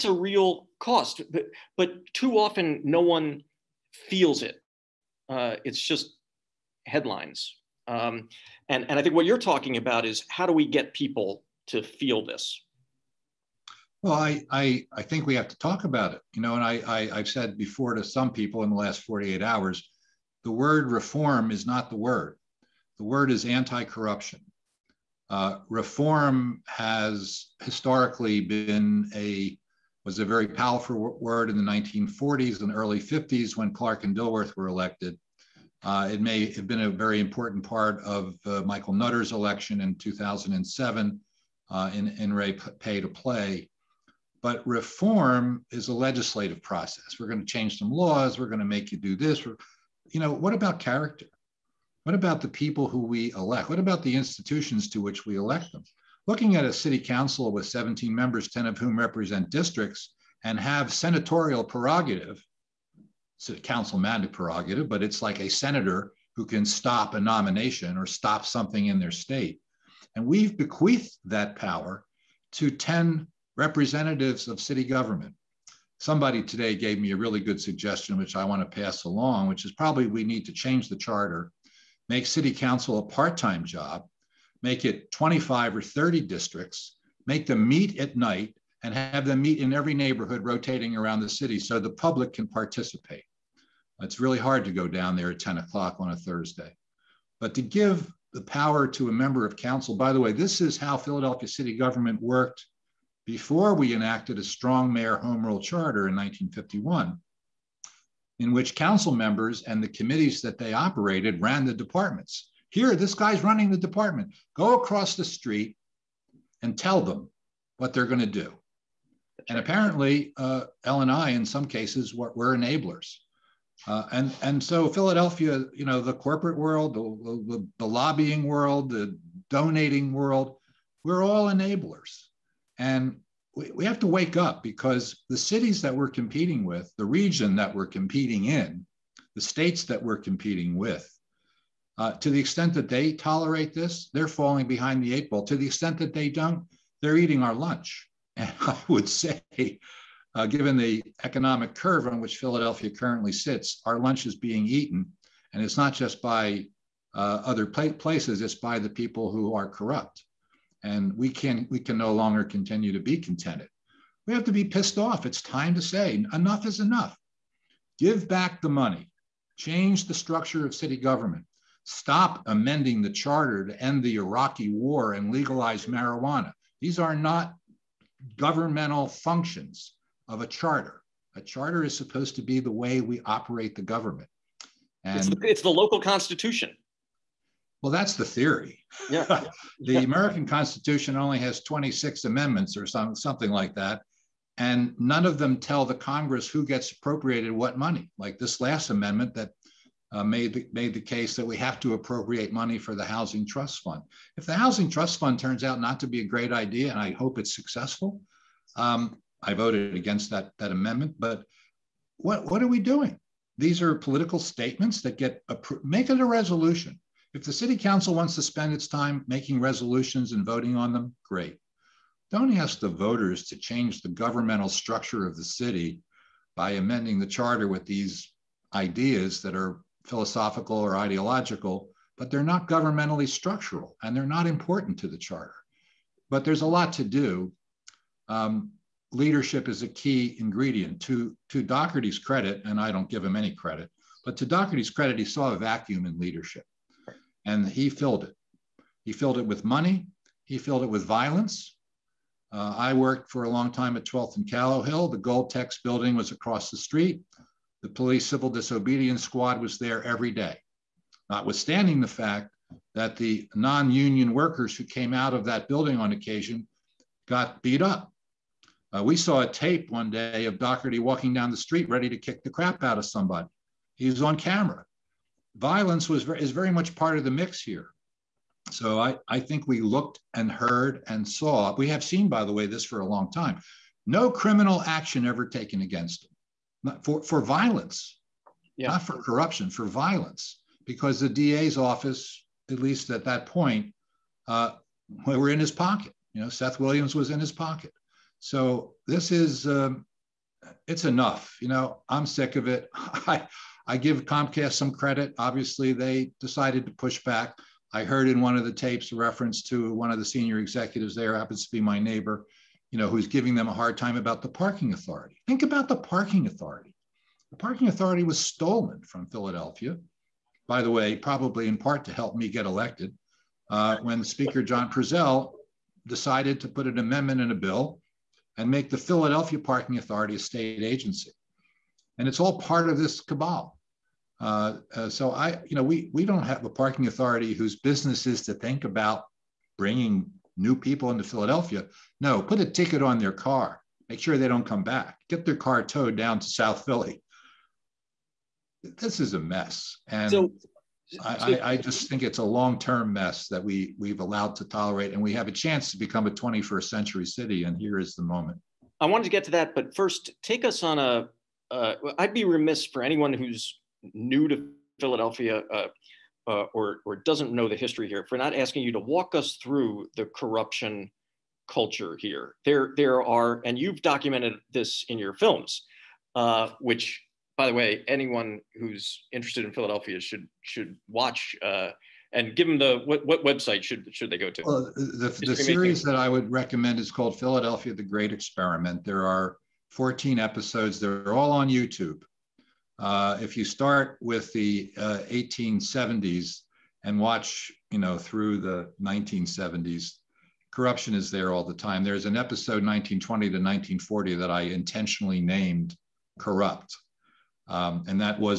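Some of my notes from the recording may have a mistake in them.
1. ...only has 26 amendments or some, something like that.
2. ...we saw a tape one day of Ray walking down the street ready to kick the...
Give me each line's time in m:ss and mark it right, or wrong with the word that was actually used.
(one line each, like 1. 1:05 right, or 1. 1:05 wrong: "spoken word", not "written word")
1. 3:11 right
2. 4:29 wrong: "Dougherty", not "Ray".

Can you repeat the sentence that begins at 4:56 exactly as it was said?
You know, Seth Williams was in his pocket.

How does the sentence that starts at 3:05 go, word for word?
And it's the, it's the local constitution.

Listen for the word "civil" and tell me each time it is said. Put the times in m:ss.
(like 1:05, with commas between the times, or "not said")
4:18.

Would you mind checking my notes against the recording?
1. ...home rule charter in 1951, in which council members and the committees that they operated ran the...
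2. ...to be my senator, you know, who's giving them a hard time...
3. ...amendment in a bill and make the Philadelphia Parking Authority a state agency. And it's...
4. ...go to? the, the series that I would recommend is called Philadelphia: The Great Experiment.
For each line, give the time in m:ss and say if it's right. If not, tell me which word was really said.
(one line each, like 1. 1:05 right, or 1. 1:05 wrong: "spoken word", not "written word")
1. 1:45 right
2. 5:11 wrong: "neighbor", not "senator"
3. 5:26 right
4. 6:24 right.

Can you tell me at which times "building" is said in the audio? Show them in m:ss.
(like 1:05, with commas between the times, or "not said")
4:15, 4:25.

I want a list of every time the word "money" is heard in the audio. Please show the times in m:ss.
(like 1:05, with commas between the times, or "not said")
2:48, 3:17, 3:22, 4:09.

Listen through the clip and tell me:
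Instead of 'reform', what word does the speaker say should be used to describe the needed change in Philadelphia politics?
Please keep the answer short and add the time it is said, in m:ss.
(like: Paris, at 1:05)
Anti-corruption, at 0:23.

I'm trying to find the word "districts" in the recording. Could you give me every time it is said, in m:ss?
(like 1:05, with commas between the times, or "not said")
0:59, 1:26.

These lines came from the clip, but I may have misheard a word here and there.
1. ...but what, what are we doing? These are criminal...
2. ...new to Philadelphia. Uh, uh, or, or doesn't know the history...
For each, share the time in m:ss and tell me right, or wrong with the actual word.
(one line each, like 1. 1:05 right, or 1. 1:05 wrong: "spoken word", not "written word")
1. 3:31 wrong: "political", not "criminal"
2. 6:04 right.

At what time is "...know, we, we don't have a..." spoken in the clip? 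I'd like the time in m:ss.
5:35.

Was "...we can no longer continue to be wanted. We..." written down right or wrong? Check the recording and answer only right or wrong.
wrong.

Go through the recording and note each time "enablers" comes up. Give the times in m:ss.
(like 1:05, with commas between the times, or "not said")
2:02, 2:11.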